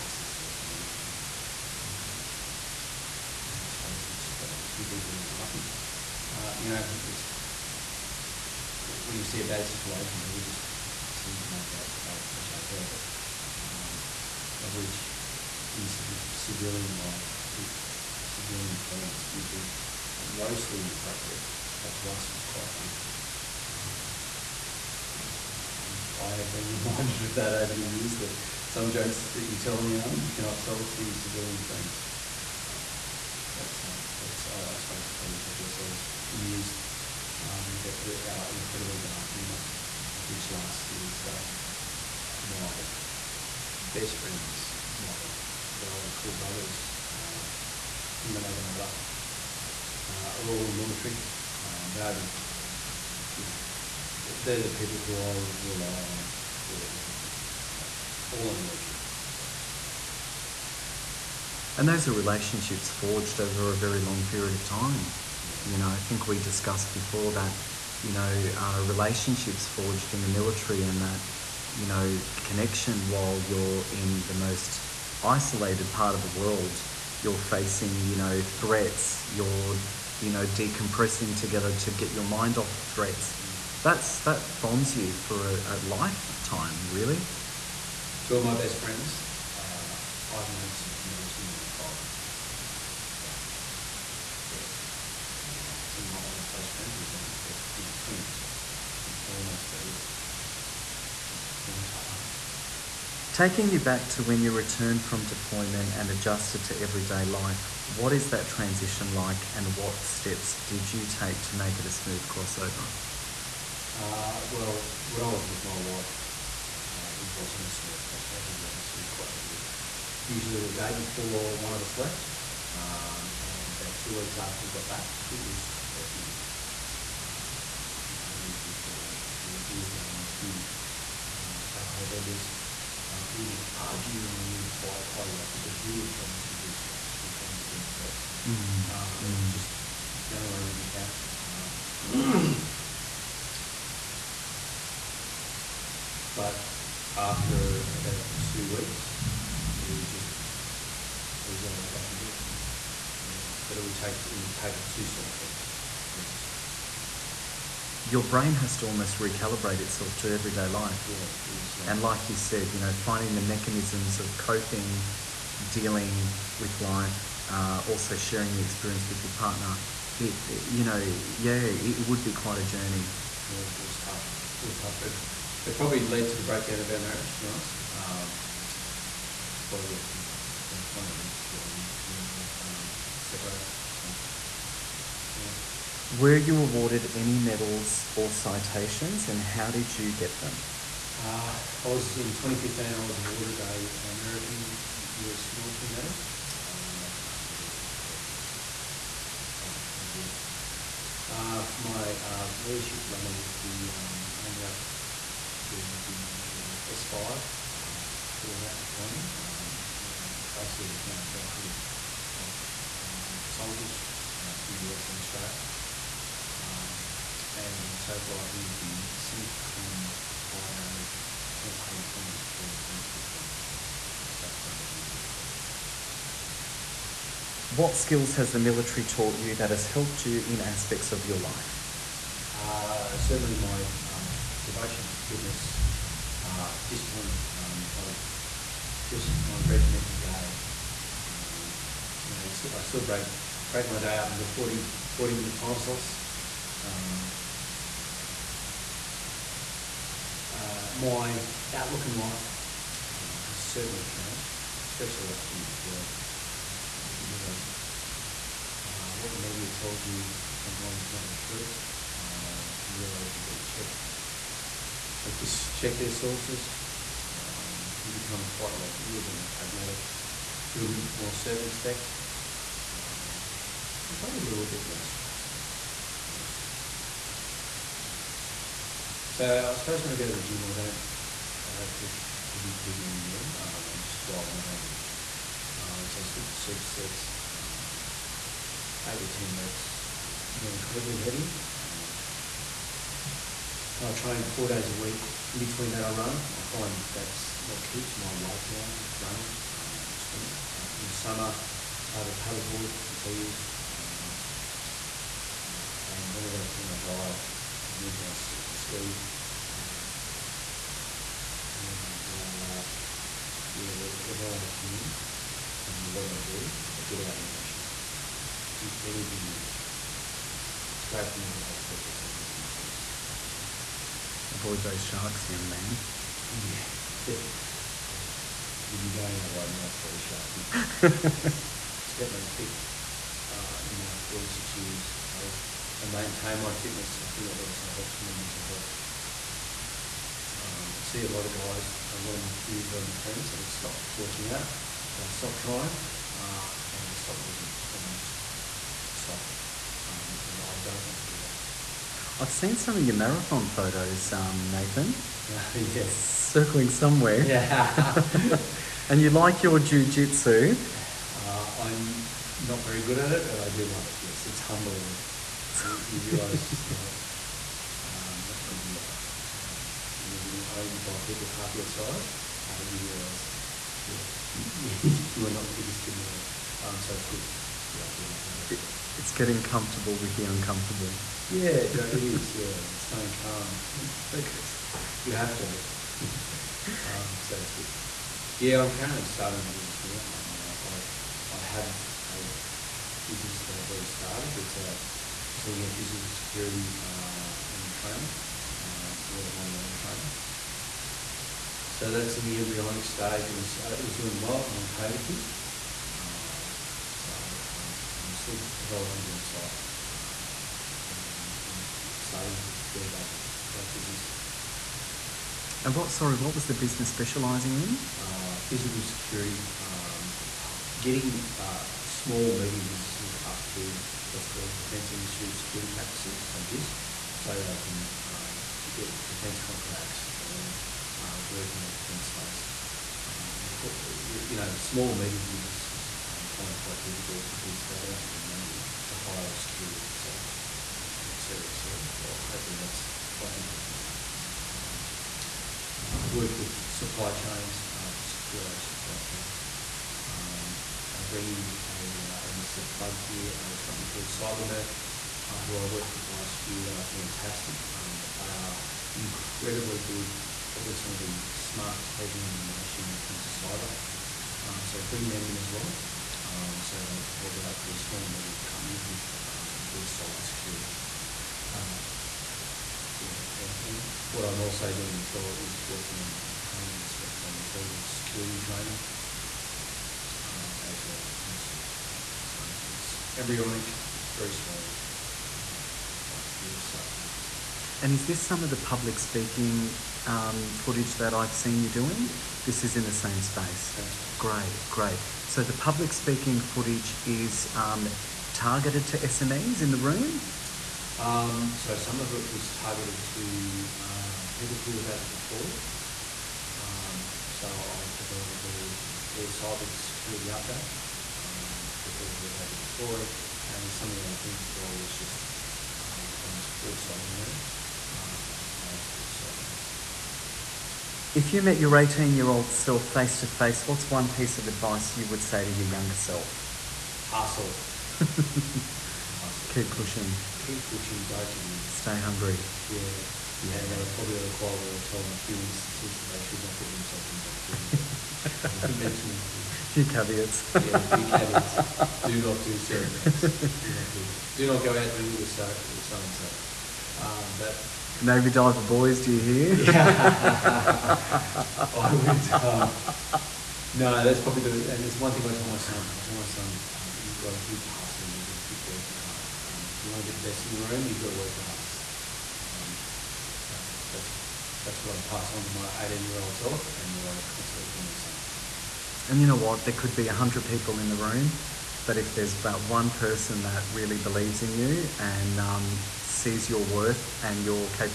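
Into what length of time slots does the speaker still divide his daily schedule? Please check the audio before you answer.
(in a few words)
40 minutes.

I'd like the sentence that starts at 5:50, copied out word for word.
Um, and I don't want to be that.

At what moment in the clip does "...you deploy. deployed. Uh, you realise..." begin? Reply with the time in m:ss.
4:15.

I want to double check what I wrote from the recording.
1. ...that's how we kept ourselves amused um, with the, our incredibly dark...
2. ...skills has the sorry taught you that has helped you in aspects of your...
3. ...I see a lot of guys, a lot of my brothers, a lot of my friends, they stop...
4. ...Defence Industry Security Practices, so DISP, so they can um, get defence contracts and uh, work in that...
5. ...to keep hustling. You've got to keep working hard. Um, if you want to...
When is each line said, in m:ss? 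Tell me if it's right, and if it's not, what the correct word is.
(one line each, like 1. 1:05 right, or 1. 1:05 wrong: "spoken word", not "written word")
1. 0:35 right
2. 3:47 wrong: "military", not "sorry"
3. 5:40 wrong: "peers", not "brothers"
4. 7:04 right
5. 9:17 right.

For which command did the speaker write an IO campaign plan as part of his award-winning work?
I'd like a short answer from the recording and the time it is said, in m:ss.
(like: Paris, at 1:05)
CENTCOM, at 3:39.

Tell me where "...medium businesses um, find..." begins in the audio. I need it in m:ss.
7:15.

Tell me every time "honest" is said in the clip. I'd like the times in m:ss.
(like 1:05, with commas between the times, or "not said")
1:58, 2:36, 2:57, 4:36.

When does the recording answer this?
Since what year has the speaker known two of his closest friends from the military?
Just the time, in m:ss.
1:31.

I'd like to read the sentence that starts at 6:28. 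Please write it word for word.
Yeah, I'm currently starting a business now.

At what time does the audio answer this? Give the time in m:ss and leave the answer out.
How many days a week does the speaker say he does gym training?
4:54.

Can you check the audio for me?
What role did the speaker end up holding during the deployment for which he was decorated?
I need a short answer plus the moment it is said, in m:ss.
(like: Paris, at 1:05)
S5, at 3:26.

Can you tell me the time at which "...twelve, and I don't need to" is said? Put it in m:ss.
4:44.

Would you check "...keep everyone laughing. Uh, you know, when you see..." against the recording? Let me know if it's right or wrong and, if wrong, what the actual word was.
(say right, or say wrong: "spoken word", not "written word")
right.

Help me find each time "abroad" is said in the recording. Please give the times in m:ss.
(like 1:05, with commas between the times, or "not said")
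not said.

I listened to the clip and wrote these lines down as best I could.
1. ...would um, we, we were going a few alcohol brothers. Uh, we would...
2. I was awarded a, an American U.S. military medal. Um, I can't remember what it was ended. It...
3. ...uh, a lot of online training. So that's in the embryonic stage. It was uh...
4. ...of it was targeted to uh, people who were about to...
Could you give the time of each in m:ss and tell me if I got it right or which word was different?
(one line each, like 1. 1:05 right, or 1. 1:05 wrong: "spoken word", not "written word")
1. 2:08 wrong: "vendors", not "brothers"
2. 3:12 wrong: "called", not "ended"
3. 6:38 right
4. 8:22 right.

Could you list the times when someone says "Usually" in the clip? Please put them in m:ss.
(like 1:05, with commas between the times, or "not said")
2:00.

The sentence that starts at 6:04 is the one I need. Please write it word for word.
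Yes, it's humbling you, you realise just how um, not good you are.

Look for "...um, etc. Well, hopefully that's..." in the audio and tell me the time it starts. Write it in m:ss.
7:21.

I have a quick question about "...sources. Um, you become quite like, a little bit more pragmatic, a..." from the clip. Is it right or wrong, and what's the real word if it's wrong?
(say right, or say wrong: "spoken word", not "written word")
right.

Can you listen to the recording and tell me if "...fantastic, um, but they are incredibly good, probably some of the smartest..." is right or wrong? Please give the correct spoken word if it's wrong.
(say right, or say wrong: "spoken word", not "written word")
right.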